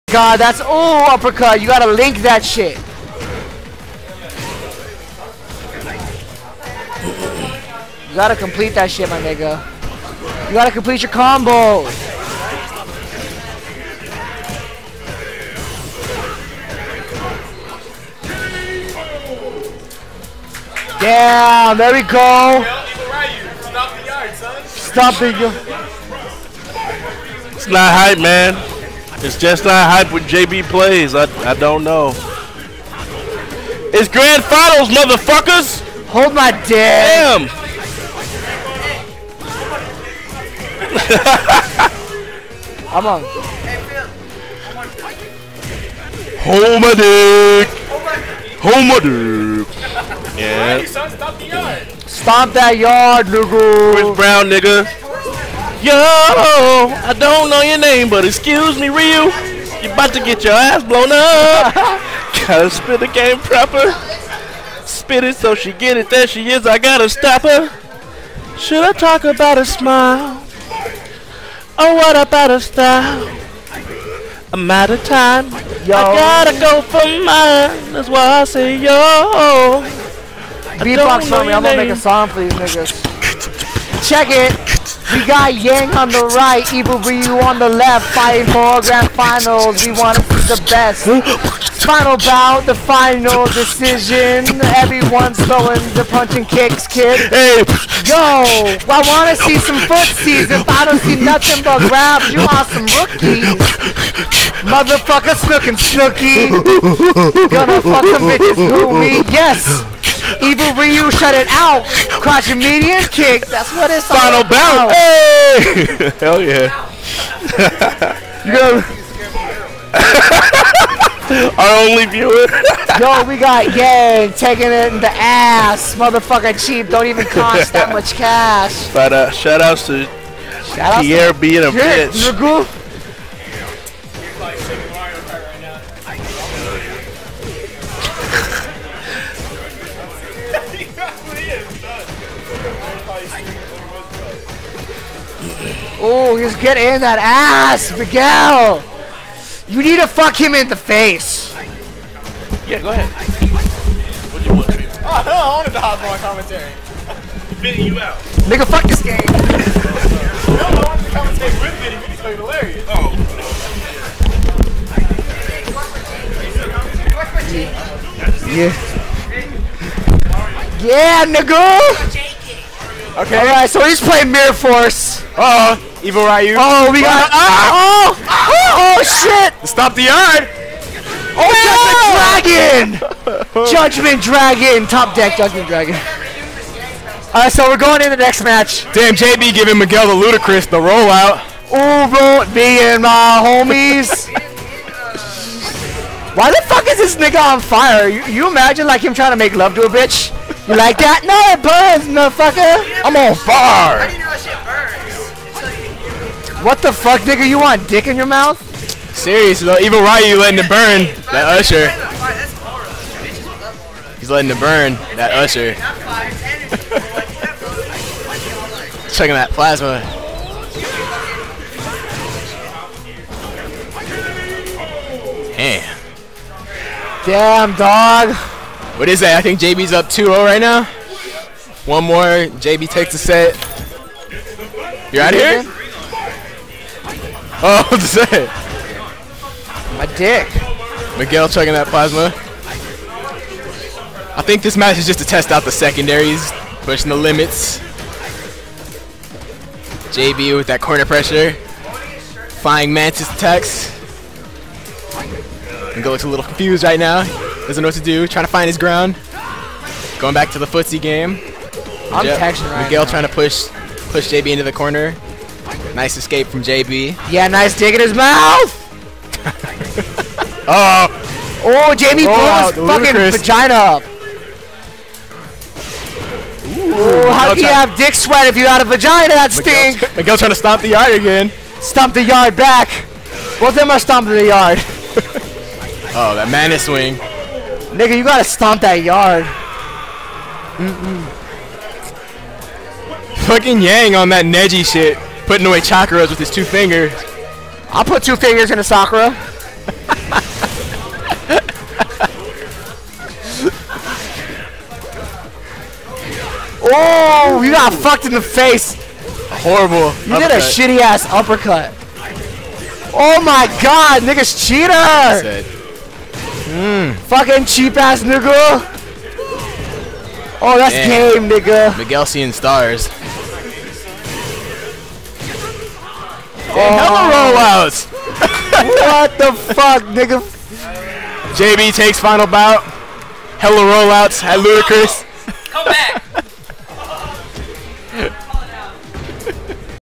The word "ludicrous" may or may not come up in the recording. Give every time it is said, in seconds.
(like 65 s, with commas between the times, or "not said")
190 s, 272 s.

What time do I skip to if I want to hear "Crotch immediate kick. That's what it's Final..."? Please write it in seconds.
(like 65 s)
112 s.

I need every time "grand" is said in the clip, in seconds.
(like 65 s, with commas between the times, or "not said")
34 s, 88 s.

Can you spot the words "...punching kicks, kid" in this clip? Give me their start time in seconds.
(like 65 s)
96 s.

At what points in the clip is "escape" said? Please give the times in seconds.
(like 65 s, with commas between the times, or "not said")
266 s.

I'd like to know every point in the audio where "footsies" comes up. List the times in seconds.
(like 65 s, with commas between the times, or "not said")
99 s, 260 s.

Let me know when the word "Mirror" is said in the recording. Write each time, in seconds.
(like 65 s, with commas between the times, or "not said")
174 s.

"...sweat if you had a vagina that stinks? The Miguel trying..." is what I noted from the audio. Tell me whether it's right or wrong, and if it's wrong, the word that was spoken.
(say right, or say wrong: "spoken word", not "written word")
right.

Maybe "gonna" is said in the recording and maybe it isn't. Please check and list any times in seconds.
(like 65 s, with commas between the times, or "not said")
81 s, 107 s.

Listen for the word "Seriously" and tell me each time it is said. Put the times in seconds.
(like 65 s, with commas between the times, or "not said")
209 s.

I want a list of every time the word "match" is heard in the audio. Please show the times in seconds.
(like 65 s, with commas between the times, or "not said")
188 s, 244 s.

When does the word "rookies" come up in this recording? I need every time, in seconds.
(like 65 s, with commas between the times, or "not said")
102 s.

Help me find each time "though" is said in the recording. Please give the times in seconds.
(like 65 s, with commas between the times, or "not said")
209 s.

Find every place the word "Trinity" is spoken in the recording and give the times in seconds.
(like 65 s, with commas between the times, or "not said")
not said.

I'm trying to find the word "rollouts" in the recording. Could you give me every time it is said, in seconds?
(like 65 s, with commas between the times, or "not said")
190 s, 327 s, 333 s.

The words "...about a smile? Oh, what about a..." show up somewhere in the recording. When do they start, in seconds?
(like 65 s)
69 s.